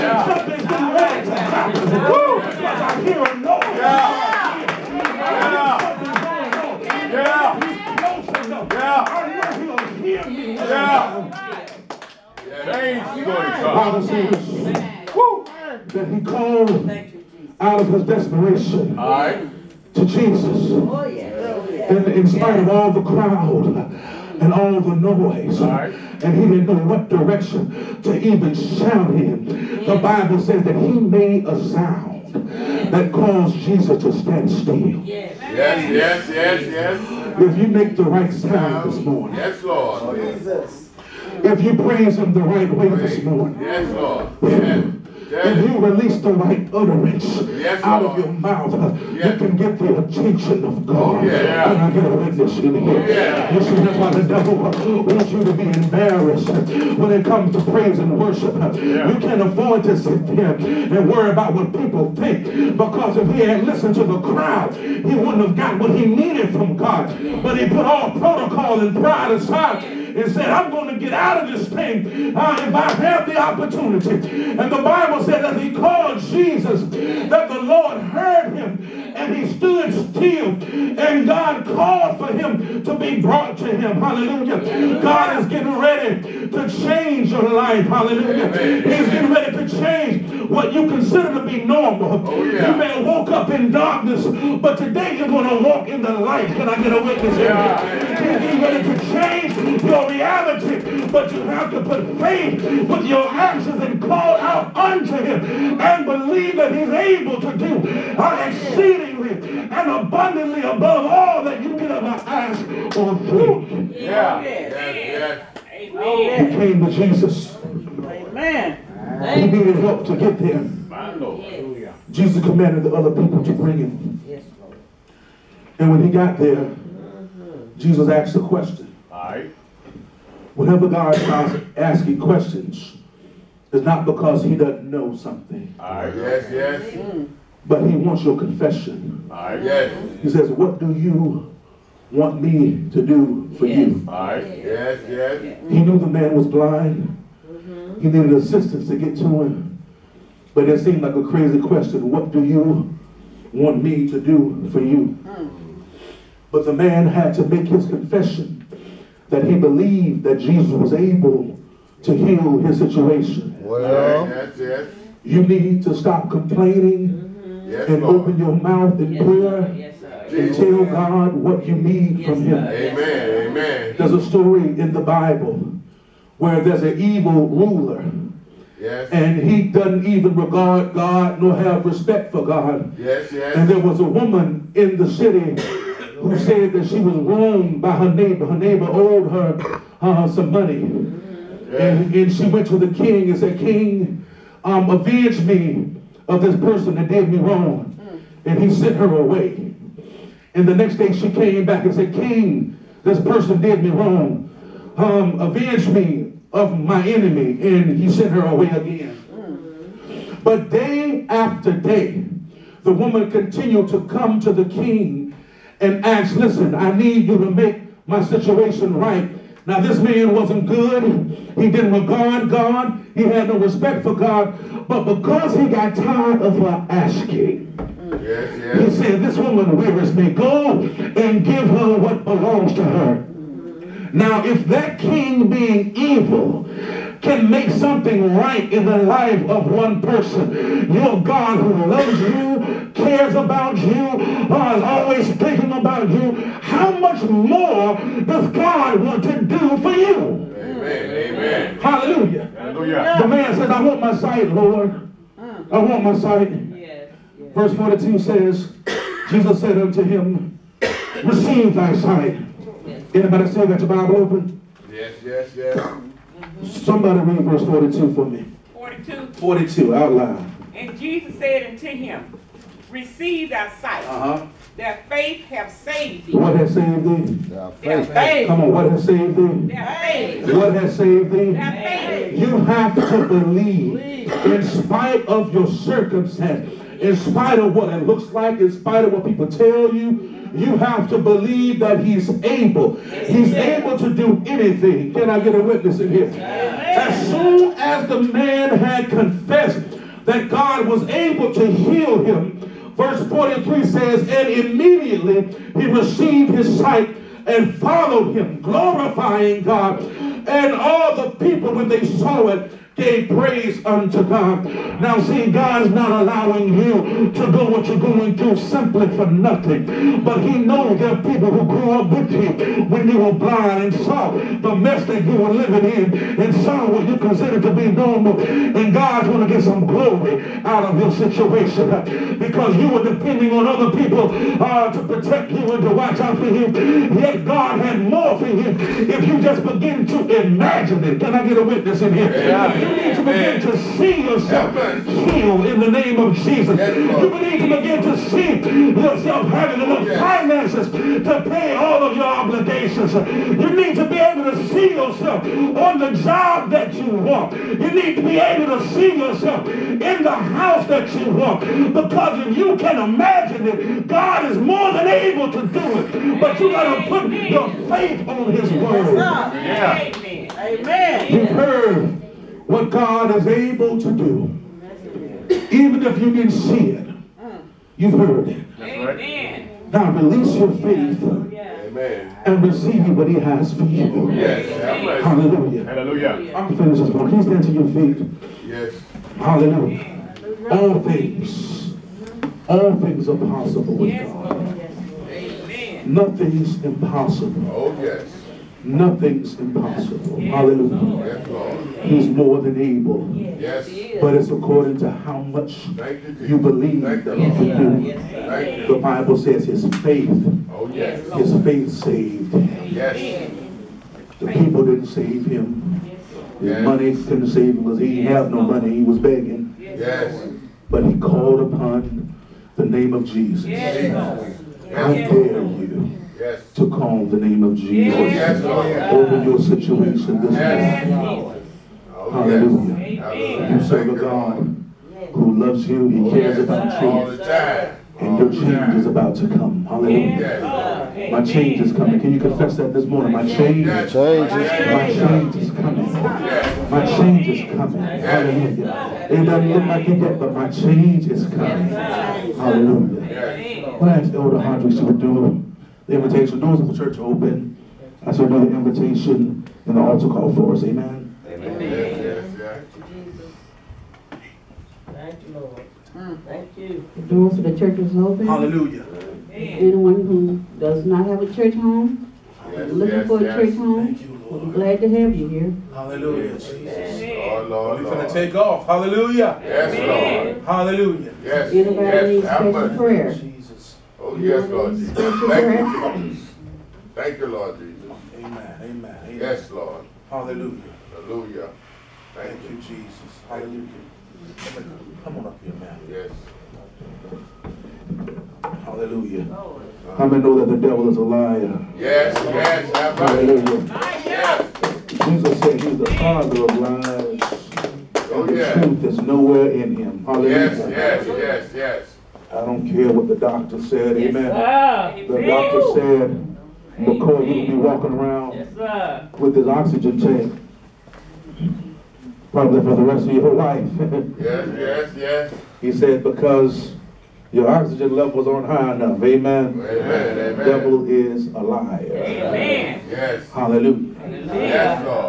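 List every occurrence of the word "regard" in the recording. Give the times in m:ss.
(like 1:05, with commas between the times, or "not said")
3:00, 3:41.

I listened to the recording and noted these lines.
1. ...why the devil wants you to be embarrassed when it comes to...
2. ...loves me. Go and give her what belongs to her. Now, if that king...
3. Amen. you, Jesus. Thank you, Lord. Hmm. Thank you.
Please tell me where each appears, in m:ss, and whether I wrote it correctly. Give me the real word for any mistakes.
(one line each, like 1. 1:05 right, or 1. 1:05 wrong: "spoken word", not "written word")
1. 0:53 right
2. 3:49 wrong: "wearies", not "loves"
3. 7:41 right.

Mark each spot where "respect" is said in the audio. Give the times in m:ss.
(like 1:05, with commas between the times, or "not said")
3:01, 3:43.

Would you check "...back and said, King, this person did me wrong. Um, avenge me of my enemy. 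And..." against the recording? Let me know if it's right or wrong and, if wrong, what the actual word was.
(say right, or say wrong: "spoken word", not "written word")
right.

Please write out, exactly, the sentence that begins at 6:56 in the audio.
His money couldn't save him because he didn't have no money.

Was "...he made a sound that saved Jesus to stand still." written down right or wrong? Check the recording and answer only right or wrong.
wrong.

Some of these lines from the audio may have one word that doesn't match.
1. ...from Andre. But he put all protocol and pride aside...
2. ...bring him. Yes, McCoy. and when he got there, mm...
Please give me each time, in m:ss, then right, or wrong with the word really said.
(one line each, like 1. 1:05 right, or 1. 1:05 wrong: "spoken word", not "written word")
1. 1:06 wrong: "God", not "Andre"
2. 2:03 wrong: "Lord", not "McCoy".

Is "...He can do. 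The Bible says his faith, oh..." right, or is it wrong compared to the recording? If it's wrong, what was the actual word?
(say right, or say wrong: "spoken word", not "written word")
right.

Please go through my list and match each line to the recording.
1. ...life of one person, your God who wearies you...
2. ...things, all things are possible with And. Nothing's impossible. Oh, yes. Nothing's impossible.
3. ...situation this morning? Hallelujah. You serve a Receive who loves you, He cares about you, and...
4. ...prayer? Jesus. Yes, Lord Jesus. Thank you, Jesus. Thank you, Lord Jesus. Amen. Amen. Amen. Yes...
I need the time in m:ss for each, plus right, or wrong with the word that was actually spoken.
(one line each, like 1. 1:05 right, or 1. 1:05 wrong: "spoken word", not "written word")
1. 3:58 wrong: "loves", not "wearies"
2. 6:31 wrong: "God", not "And"
3. 7:09 wrong: "God", not "Receive"
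4. 8:02 right.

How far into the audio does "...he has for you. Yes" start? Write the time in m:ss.
6:23.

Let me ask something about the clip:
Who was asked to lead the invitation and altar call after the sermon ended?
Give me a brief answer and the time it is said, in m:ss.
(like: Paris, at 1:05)
Elder Andre, at 7:34.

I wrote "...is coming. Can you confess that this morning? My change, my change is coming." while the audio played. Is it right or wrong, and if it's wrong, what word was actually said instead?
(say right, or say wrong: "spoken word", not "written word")
right.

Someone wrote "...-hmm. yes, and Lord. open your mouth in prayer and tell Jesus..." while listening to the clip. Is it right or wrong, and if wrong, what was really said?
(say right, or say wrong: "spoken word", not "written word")
wrong: "God", not "Jesus".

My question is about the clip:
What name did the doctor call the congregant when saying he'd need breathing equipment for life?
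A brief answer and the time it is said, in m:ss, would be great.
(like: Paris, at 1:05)
McCoy, at 8:36.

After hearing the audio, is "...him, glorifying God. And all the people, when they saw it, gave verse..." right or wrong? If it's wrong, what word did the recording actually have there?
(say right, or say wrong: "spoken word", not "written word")
wrong: "praise", not "verse".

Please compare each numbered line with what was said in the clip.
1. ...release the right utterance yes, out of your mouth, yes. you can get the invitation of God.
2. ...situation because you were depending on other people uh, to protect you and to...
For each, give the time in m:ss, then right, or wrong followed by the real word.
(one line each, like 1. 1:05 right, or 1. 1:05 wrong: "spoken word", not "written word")
1. 0:45 wrong: "attention", not "invitation"
2. 5:31 right.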